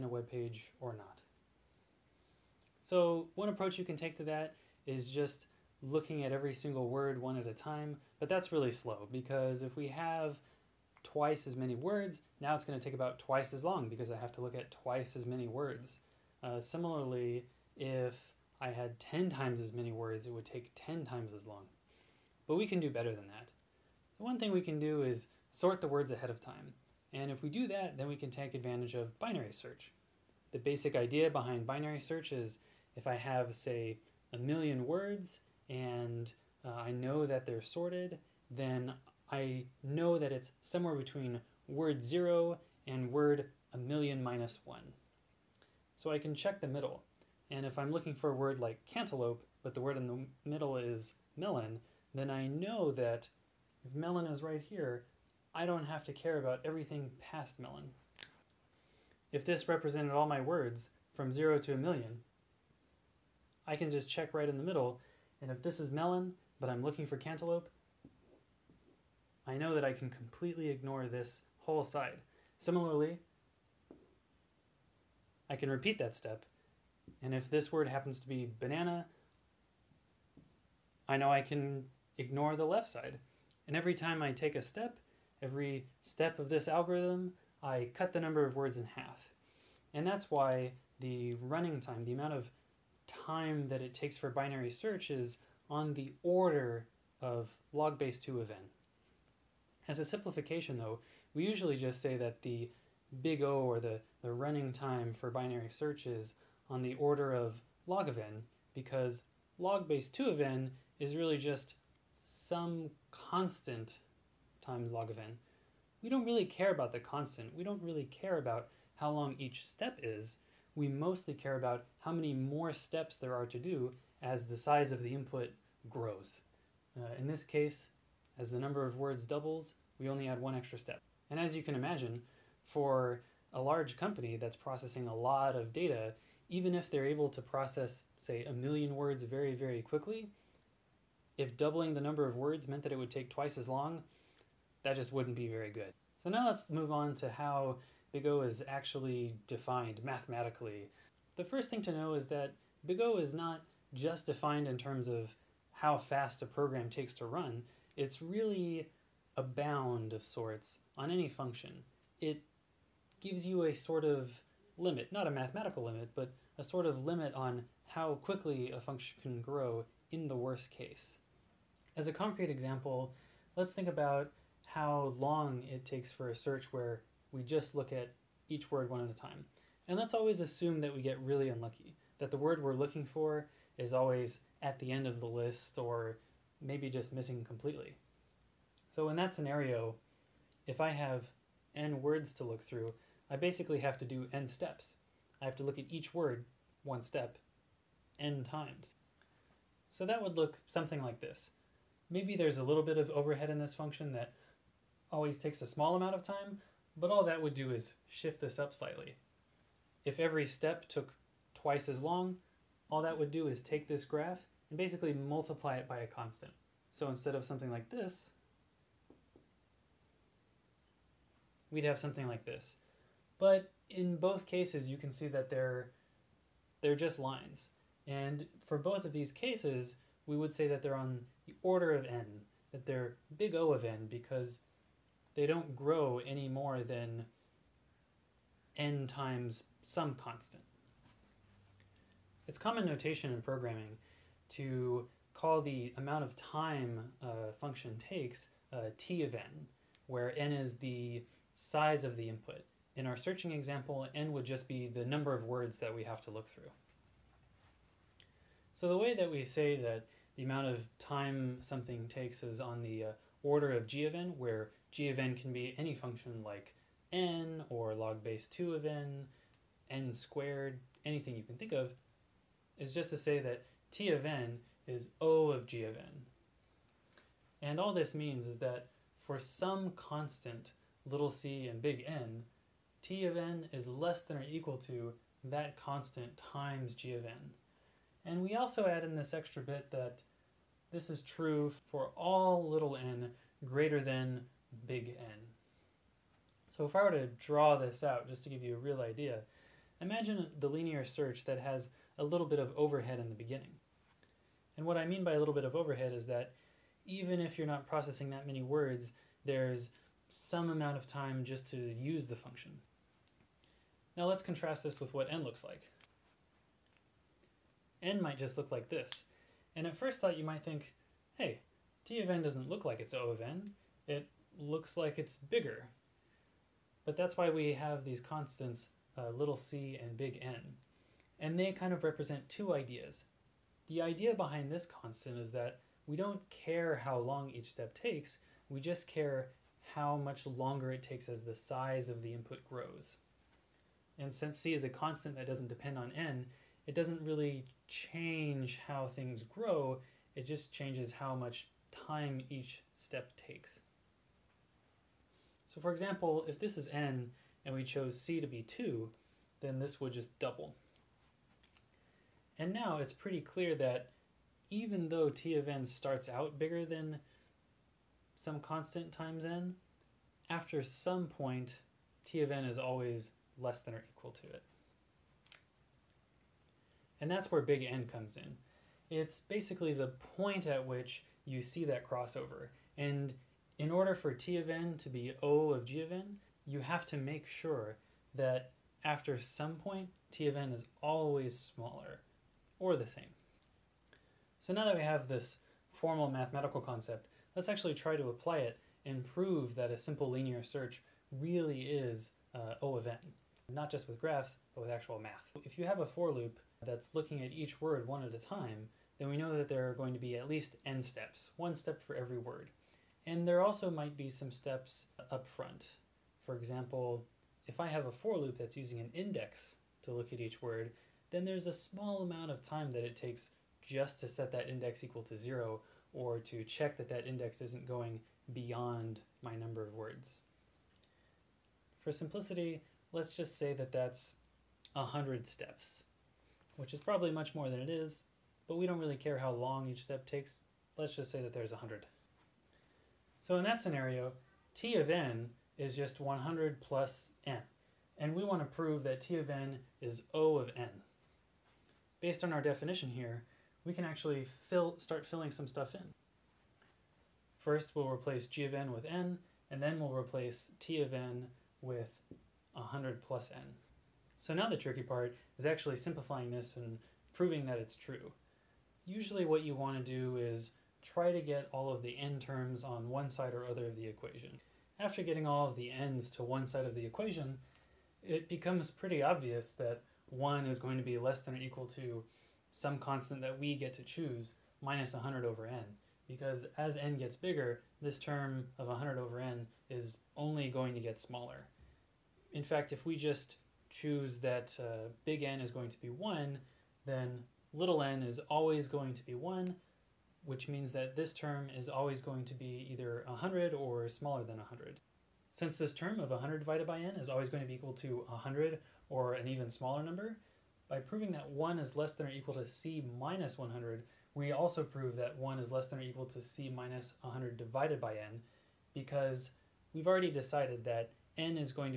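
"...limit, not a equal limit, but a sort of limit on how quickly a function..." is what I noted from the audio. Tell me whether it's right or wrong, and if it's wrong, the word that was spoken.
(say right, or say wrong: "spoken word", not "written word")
wrong: "mathematical", not "equal".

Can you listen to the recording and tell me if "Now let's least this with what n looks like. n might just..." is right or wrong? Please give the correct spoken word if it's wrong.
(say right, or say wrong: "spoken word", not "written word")
wrong: "contrast", not "least".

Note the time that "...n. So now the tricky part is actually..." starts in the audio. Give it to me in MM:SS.
07:43.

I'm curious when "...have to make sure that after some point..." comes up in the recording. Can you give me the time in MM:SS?
06:26.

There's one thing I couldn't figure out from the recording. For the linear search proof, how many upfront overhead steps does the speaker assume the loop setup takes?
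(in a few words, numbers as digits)
100.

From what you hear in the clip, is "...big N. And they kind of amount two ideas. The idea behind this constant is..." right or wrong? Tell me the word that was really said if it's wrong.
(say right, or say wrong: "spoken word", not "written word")
wrong: "represent", not "amount".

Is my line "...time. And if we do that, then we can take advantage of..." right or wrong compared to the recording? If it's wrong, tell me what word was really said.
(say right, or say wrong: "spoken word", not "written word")
right.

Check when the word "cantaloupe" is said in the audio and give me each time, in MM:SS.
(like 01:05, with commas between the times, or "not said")
00:48, 01:07.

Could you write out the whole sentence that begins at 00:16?
Uh, similarly, if I had 10 times as many words, it would take 10 times as long.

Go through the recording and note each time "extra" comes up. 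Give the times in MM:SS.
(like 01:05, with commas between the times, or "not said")
02:10, 04:49.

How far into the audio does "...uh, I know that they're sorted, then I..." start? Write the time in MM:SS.
00:36.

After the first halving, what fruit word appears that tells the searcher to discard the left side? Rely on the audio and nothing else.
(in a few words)
banana.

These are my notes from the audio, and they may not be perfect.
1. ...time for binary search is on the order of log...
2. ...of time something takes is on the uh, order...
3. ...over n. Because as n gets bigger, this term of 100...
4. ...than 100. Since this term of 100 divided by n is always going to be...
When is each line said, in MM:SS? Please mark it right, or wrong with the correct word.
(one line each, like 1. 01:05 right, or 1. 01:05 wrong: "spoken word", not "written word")
1. 01:44 right
2. 04:20 right
3. 08:05 right
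4. 08:24 right.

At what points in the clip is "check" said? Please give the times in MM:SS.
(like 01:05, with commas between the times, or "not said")
00:46, 01:04, 07:06.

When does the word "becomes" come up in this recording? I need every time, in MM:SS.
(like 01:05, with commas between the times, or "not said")
07:58.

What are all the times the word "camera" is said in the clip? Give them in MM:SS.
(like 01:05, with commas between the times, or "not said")
not said.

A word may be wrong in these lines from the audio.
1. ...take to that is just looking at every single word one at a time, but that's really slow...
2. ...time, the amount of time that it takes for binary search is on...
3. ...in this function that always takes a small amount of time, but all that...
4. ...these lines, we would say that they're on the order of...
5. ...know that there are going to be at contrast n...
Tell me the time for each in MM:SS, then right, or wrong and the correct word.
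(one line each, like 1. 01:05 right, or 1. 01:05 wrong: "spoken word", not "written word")
1. 00:03 right
2. 01:31 right
3. 03:23 right
4. 03:49 wrong: "cases", not "lines"
5. 06:49 wrong: "least", not "contrast".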